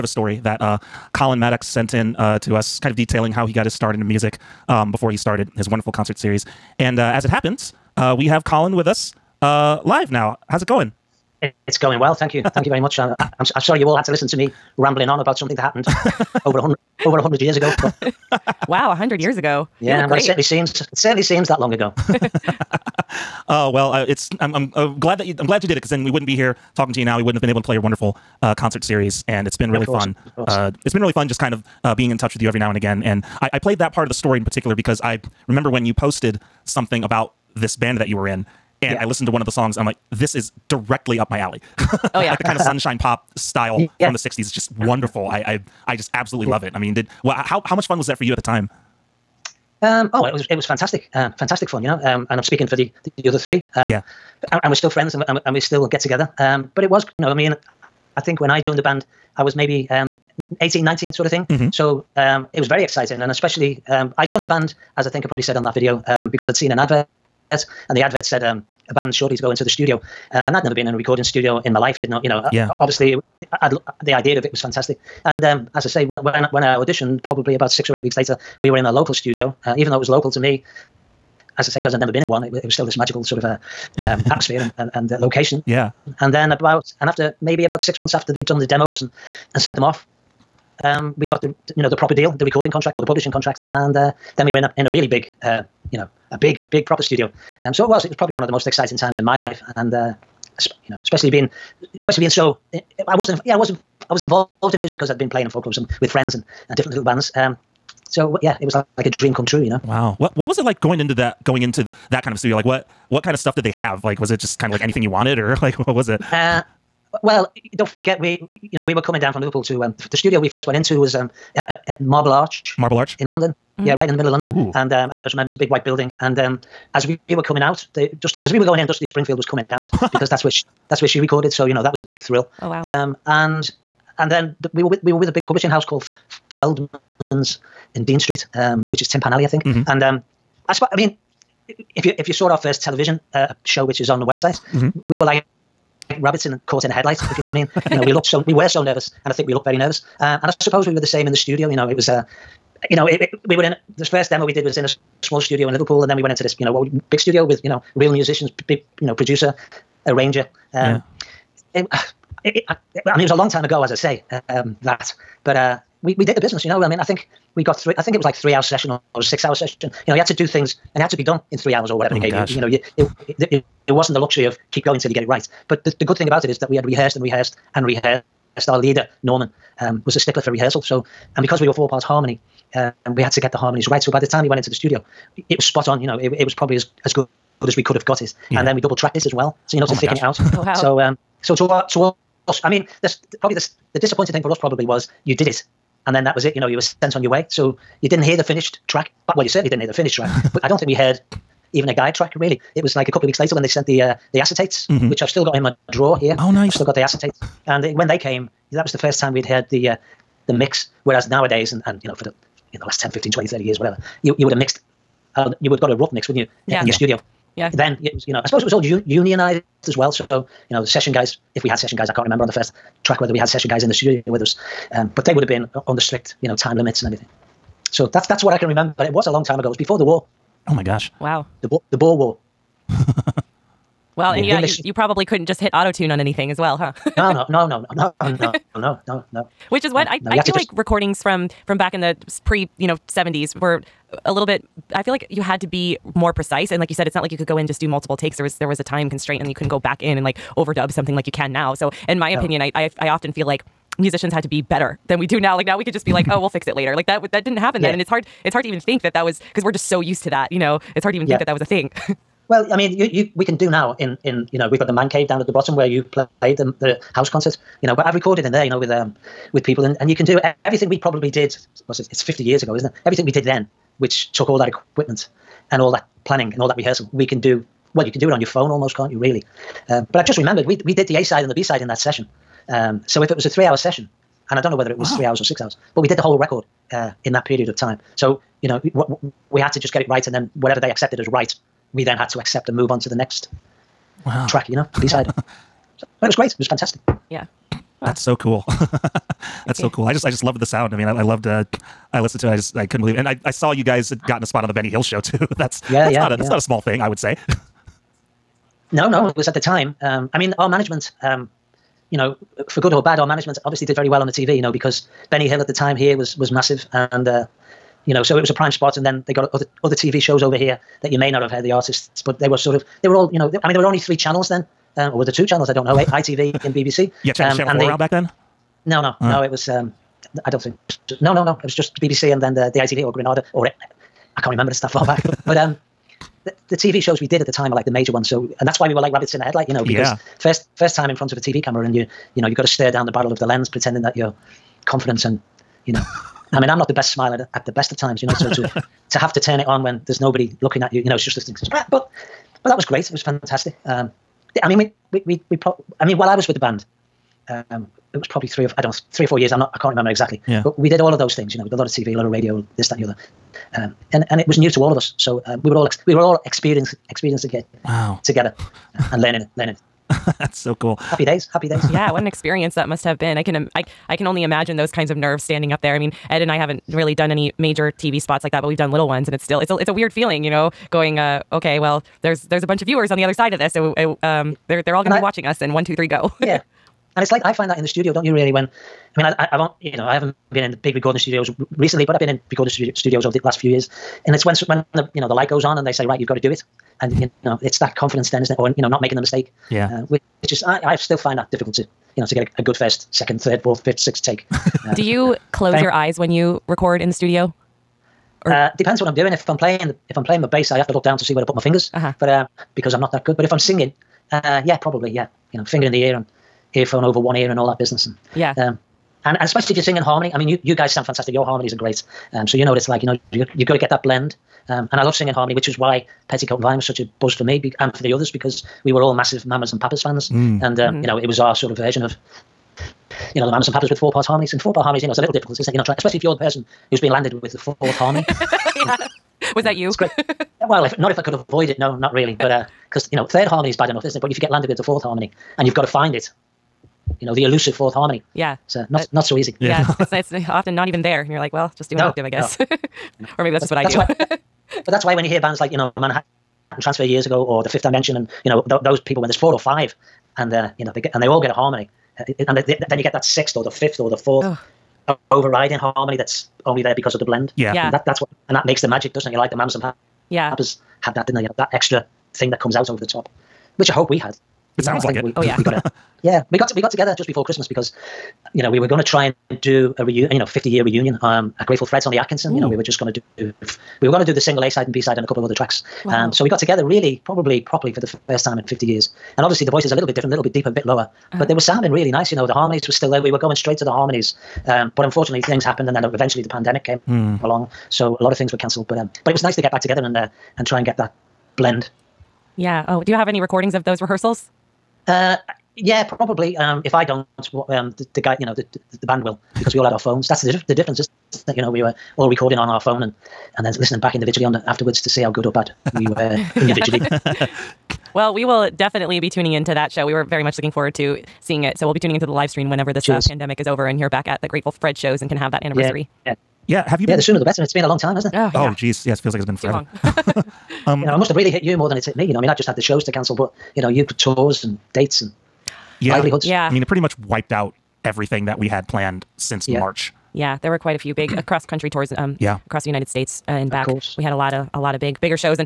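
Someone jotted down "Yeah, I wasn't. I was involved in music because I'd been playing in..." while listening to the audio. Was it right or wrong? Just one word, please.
right.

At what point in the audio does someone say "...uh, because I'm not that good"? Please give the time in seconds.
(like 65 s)
412 s.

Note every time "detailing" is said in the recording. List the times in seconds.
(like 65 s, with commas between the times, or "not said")
2 s.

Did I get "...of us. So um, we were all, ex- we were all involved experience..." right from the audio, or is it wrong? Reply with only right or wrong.
wrong.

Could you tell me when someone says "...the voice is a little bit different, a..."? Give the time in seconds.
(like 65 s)
489 s.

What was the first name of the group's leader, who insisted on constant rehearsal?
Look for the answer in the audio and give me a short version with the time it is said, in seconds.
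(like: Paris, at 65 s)
Norman, at 179 s.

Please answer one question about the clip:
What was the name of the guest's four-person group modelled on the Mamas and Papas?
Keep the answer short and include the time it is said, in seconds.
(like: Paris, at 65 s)
Petticoat and Vine, at 426 s.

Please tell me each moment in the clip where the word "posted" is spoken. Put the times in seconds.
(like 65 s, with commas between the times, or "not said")
35 s.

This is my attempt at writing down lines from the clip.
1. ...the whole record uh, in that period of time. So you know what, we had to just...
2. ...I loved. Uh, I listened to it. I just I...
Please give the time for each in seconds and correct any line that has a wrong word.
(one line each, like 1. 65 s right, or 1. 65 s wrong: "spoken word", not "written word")
1. 286 s right
2. 301 s right.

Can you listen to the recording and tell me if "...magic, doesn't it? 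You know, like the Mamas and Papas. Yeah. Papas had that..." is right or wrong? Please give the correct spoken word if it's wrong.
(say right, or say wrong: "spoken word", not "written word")
right.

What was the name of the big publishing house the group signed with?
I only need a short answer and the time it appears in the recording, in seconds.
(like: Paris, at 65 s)
Feldman's, at 136 s.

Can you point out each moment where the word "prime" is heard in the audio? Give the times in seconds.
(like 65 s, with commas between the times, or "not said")
318 s.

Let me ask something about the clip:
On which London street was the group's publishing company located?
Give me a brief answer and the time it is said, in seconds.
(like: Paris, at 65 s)
Dean Street, at 138 s.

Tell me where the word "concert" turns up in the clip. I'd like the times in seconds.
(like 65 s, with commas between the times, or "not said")
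5 s, 28 s, 267 s.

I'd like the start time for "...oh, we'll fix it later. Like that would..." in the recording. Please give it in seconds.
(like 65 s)
256 s.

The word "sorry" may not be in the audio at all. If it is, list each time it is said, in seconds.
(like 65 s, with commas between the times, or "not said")
13 s.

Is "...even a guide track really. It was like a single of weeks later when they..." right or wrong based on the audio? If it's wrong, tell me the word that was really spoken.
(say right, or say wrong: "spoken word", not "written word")
wrong: "couple", not "single".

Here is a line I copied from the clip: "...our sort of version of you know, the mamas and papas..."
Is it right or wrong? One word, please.
right.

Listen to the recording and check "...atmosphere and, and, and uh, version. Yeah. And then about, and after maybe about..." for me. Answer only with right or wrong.
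wrong.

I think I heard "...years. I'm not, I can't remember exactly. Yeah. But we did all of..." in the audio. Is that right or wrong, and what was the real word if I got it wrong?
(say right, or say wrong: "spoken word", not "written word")
right.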